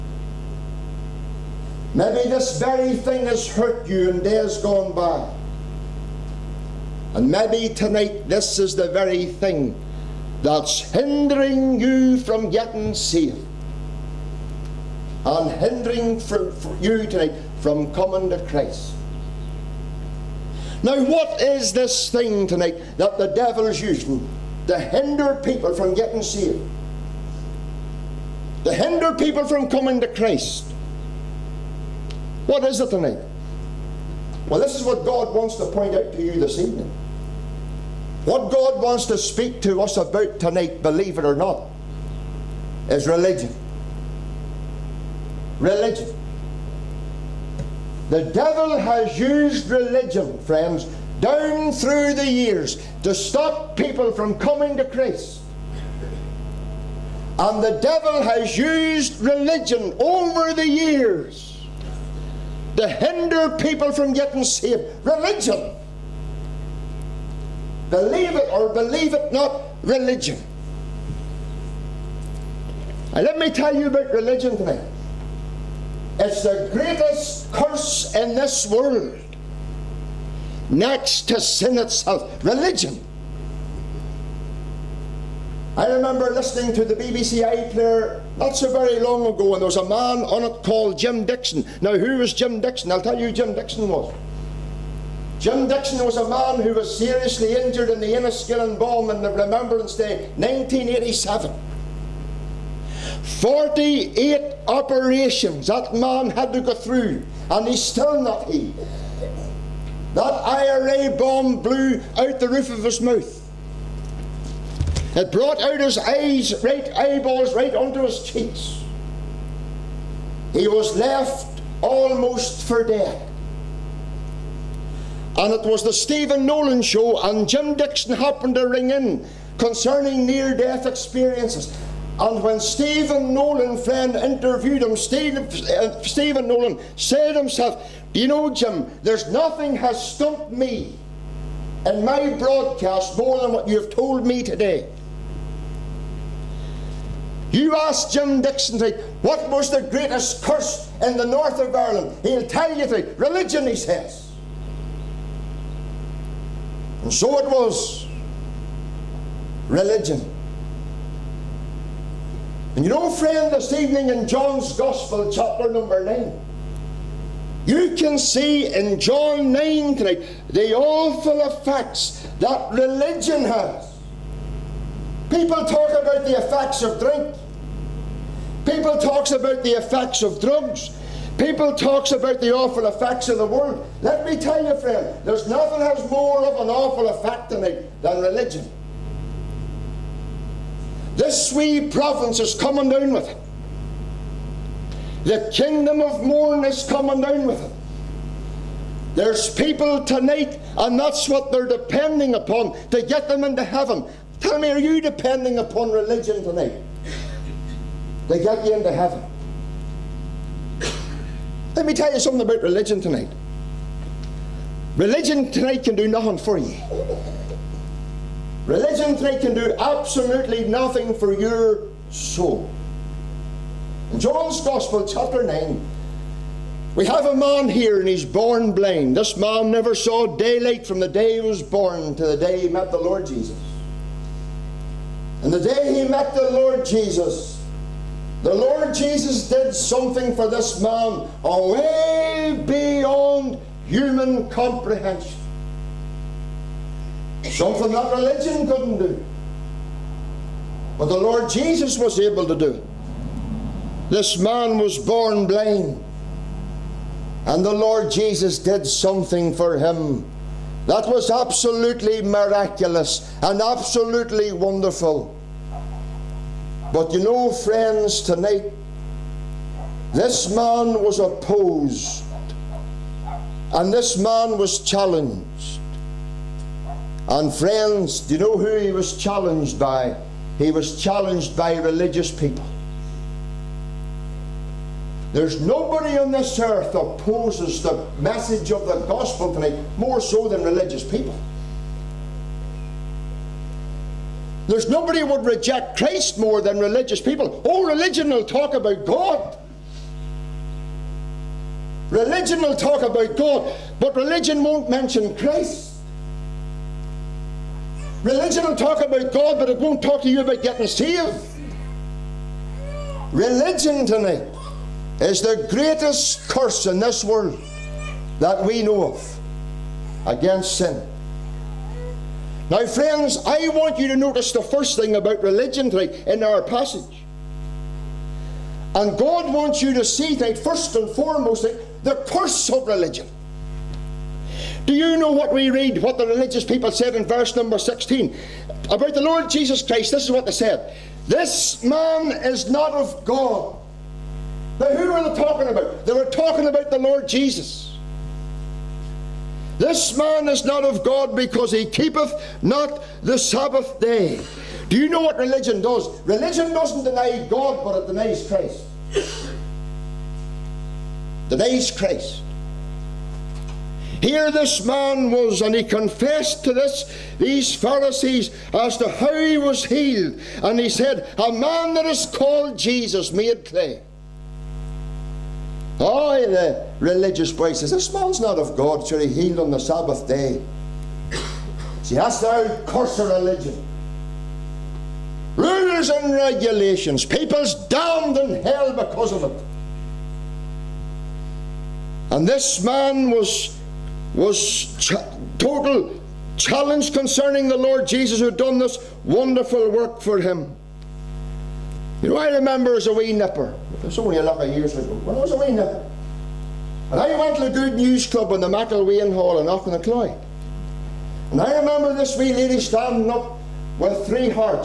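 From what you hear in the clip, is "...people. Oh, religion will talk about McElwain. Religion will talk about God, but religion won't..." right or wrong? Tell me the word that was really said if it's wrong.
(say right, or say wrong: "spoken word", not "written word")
wrong: "God", not "McElwain".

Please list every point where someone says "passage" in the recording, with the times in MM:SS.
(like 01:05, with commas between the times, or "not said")
05:26.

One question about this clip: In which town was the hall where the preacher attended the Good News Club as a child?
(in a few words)
Aughnacloy.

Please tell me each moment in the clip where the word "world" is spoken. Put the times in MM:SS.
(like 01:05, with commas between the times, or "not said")
01:18, 03:03, 05:17.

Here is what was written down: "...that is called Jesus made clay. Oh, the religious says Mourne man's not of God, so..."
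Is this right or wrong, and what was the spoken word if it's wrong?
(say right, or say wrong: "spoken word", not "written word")
wrong: "This", not "Mourne".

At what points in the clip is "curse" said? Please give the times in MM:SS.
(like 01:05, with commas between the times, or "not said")
01:17, 02:30, 05:16, 05:32, 06:22.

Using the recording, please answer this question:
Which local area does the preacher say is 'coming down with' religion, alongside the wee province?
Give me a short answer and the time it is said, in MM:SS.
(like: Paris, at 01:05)
The kingdom of Mourne, at 03:15.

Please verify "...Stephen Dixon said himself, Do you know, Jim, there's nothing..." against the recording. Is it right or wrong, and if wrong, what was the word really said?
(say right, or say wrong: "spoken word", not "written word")
wrong: "Nolan", not "Dixon".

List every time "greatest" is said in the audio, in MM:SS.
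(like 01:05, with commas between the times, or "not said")
01:16, 02:29, 05:15.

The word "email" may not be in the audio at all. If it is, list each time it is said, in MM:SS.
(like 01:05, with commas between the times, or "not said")
not said.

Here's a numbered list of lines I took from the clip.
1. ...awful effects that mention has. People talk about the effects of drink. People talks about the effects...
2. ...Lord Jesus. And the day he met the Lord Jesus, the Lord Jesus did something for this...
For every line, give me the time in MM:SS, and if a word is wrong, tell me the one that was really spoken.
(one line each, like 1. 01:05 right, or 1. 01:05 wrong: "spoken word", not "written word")
1. 02:50 wrong: "religion", not "mention"
2. 03:52 right.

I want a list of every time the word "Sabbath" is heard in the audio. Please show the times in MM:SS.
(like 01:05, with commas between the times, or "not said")
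05:53, 06:19.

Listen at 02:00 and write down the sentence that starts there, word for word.
He was left almost for dead.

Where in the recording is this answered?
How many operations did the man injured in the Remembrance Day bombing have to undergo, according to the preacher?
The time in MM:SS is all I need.
01:43.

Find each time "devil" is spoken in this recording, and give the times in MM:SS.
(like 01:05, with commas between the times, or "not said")
00:23, 00:48, 00:57.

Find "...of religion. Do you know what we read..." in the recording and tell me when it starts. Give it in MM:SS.
05:32.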